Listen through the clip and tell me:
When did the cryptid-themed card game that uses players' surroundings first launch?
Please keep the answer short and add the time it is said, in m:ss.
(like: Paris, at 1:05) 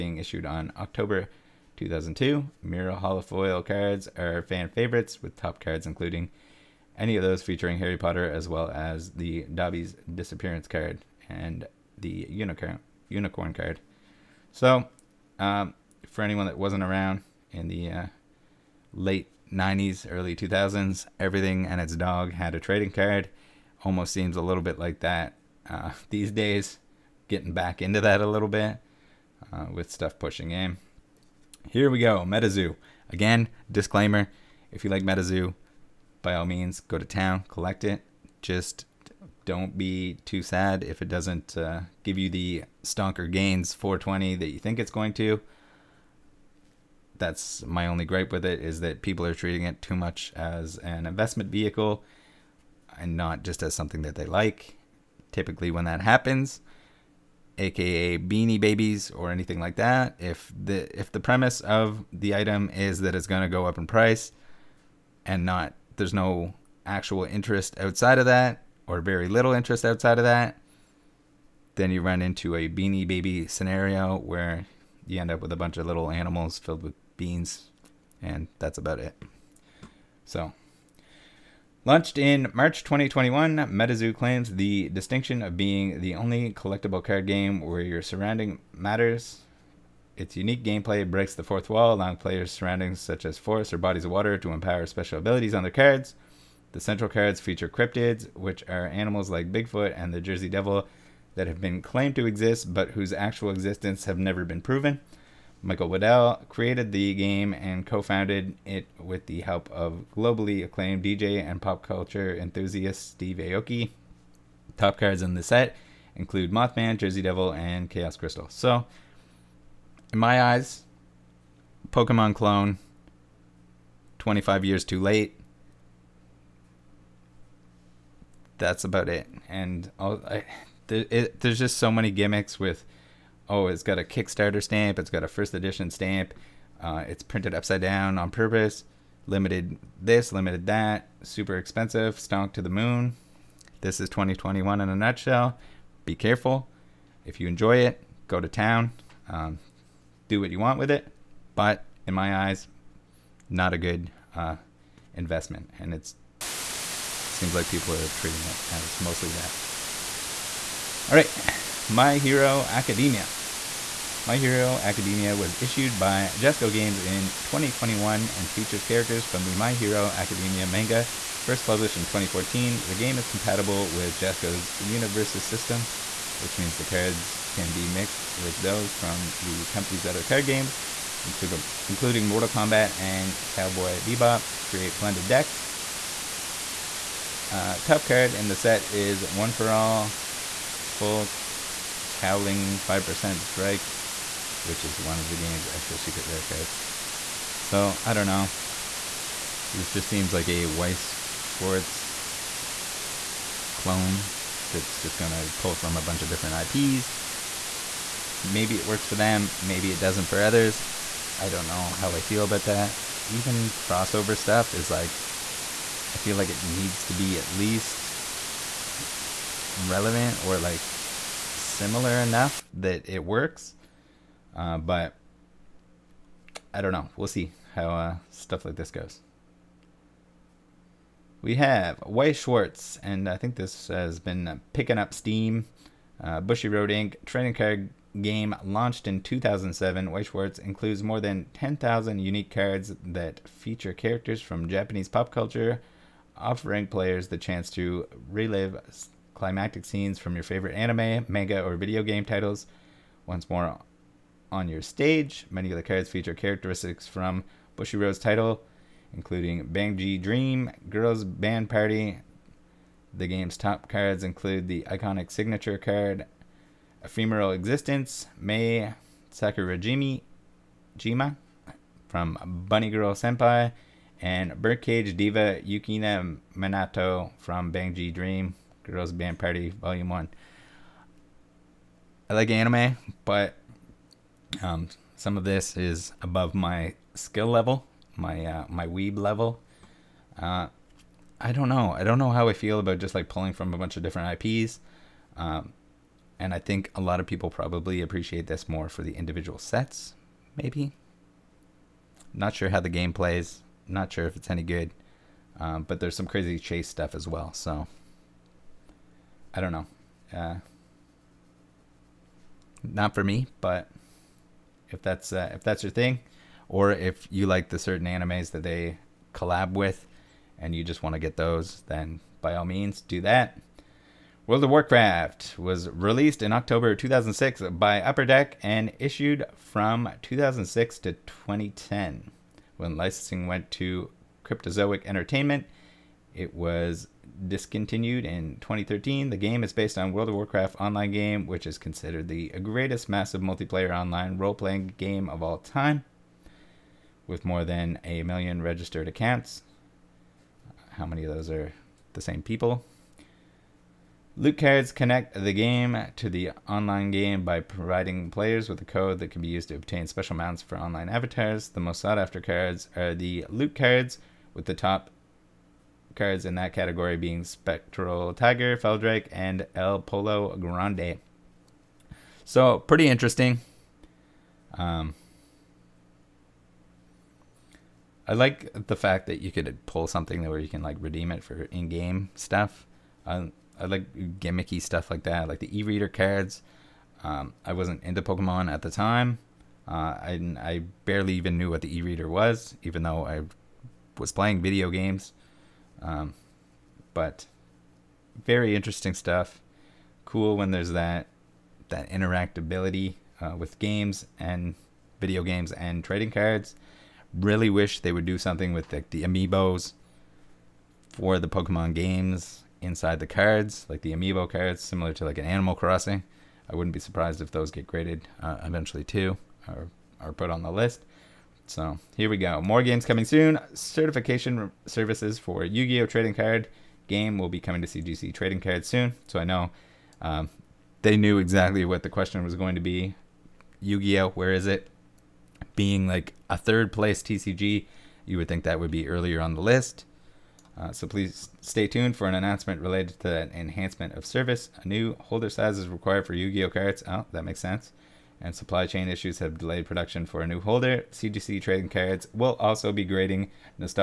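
March 2021, at 1:22.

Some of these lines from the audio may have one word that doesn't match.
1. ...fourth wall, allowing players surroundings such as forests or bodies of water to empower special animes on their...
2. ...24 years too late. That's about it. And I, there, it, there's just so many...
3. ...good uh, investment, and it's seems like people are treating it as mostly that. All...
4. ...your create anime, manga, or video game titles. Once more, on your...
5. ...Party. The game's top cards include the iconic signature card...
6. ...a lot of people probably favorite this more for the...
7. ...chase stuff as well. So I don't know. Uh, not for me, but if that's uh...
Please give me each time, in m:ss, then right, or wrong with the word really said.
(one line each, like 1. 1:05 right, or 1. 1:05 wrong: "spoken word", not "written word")
1. 1:31 wrong: "abilities", not "animes"
2. 2:04 wrong: "25", not "24"
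3. 2:33 right
4. 4:10 wrong: "favorite", not "create"
5. 4:21 right
6. 4:56 wrong: "appreciate", not "favorite"
7. 5:06 right.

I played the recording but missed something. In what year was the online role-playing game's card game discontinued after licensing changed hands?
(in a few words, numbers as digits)
2013.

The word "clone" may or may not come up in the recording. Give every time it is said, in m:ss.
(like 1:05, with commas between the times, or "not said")
2:02, 3:23.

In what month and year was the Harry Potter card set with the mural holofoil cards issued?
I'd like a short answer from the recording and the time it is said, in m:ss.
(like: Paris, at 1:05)
October 2002, at 0:00.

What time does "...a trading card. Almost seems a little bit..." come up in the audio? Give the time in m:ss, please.
0:22.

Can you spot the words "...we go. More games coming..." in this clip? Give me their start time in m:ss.
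7:02.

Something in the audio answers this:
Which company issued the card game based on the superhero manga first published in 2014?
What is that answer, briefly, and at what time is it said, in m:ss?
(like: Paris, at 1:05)
Jasco Games, at 2:46.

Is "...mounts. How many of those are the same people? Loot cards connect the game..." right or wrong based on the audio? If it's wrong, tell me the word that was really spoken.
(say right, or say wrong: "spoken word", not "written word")
wrong: "accounts", not "mounts".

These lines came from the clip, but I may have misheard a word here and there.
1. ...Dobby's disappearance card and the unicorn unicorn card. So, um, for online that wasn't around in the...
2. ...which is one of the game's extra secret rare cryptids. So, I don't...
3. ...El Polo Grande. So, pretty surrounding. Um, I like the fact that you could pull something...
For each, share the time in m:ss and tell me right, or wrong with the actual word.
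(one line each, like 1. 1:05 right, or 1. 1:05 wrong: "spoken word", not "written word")
1. 0:09 wrong: "anyone", not "online"
2. 3:14 wrong: "cards", not "cryptids"
3. 6:09 wrong: "interesting", not "surrounding".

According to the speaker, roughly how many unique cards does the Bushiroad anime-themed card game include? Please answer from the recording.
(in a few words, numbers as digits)
more than 10,000.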